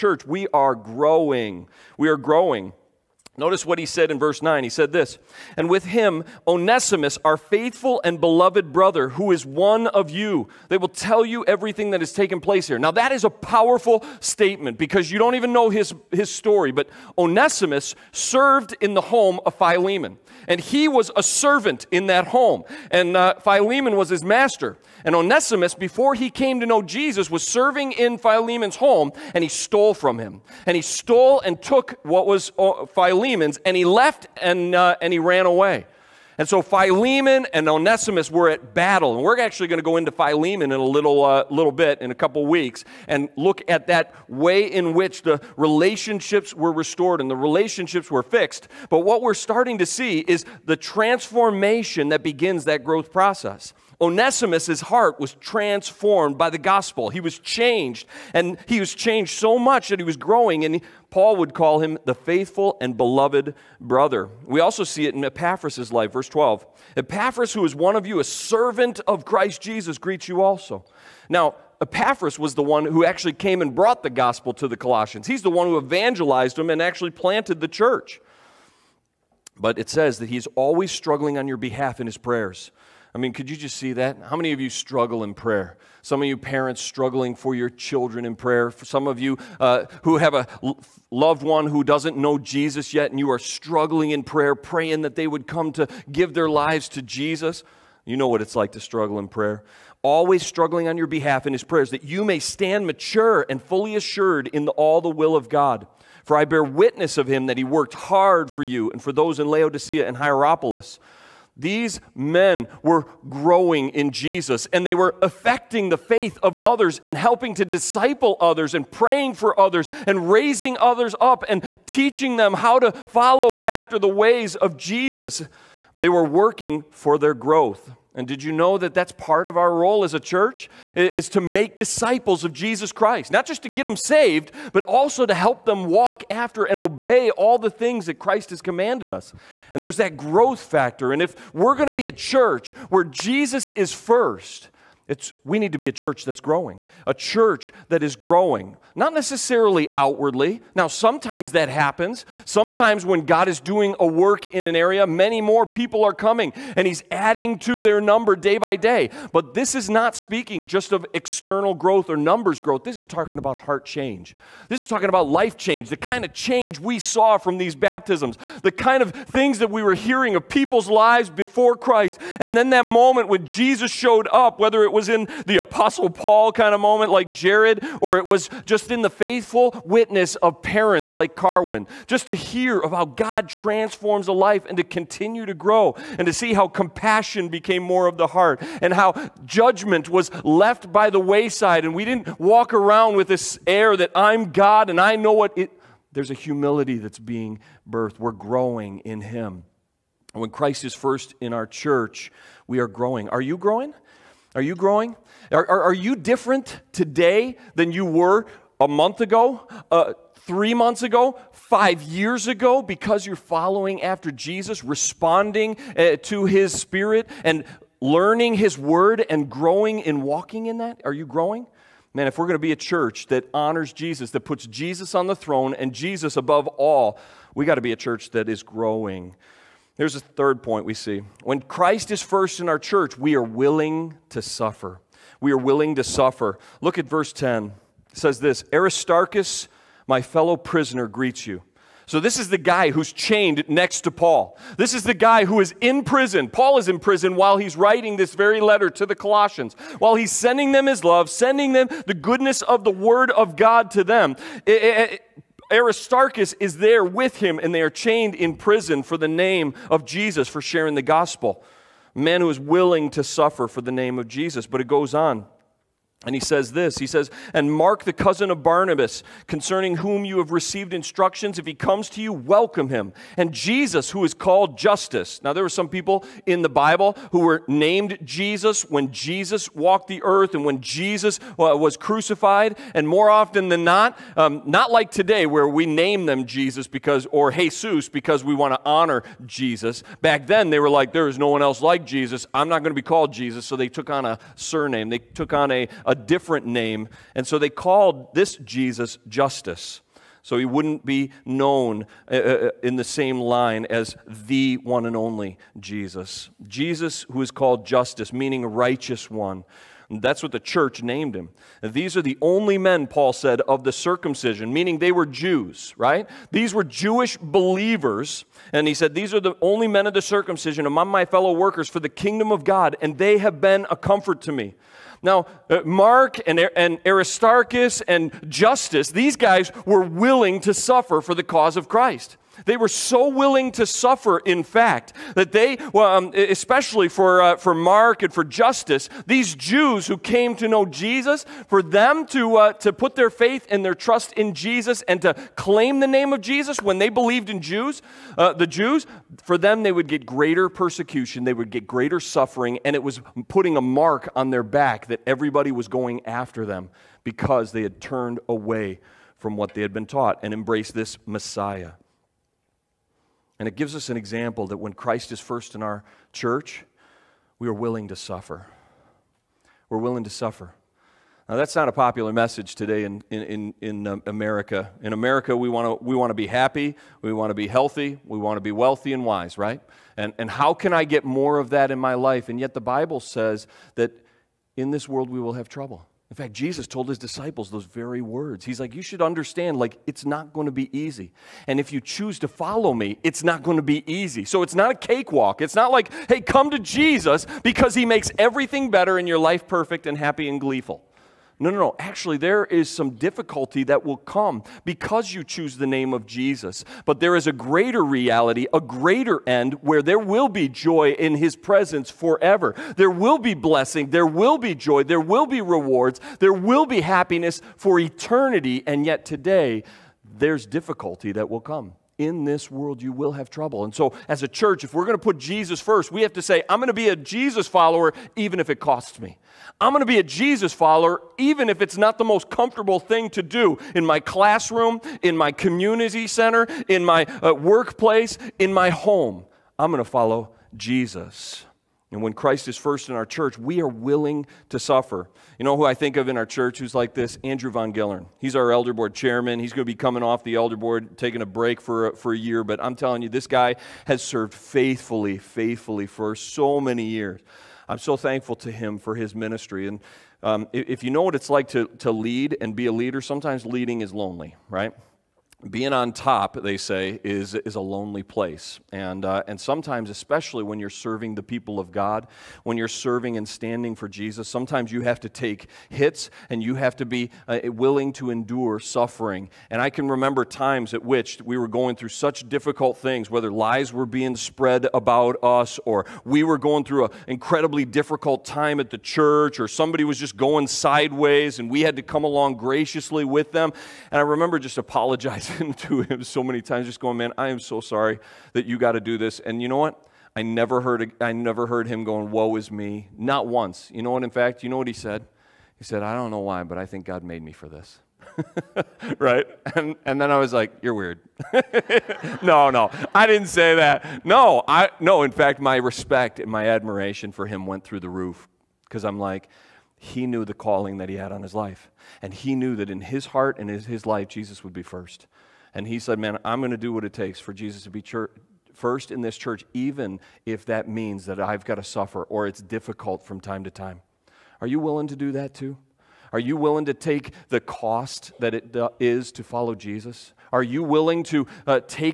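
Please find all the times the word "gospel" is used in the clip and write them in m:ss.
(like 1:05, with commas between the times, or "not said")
0:56, 1:14, 4:21.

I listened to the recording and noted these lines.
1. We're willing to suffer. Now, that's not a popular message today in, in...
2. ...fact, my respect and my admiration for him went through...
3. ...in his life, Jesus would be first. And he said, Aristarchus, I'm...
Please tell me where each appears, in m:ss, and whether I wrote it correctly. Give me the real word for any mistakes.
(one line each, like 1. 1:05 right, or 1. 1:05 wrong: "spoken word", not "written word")
1. 6:09 right
2. 8:35 right
3. 8:43 wrong: "Man", not "Aristarchus".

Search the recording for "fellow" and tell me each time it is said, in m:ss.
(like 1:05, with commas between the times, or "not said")
4:00, 5:21.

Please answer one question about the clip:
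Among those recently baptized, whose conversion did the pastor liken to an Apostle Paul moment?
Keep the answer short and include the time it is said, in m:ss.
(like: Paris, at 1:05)
Jared, at 2:57.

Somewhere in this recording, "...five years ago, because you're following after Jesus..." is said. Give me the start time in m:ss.
3:31.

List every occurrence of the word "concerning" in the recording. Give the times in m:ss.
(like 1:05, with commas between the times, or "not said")
4:29.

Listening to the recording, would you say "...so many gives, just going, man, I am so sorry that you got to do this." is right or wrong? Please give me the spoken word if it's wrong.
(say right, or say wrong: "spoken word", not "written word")
wrong: "times", not "gives".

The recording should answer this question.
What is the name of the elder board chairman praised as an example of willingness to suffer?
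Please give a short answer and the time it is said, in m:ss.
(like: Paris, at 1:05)
Andrew Von Gellern, at 7:27.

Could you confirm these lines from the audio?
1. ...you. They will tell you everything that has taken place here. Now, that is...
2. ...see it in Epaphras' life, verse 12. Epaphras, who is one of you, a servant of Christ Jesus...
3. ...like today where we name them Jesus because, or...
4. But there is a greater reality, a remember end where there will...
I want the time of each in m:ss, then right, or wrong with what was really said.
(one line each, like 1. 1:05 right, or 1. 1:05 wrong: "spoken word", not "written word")
1. 0:10 right
2. 1:04 right
3. 4:44 right
4. 6:47 wrong: "greater", not "remember".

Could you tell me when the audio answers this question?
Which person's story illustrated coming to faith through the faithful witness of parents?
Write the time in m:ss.
3:01.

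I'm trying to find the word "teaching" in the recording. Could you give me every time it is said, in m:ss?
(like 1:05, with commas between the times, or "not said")
2:01.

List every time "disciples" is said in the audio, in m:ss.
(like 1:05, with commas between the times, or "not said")
1:57, 2:11, 6:27.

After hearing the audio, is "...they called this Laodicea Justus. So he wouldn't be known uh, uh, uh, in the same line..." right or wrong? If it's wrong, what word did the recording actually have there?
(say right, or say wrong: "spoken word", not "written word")
wrong: "Jesus", not "Laodicea".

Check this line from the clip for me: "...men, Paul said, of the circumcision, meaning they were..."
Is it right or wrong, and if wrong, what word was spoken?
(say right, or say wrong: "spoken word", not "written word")
right.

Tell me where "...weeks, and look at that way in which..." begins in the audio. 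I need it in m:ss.
0:42.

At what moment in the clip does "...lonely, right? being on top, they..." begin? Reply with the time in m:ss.
7:44.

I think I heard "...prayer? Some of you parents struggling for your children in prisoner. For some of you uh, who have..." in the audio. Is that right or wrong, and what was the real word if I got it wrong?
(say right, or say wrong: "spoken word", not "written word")
wrong: "prayer", not "prisoner".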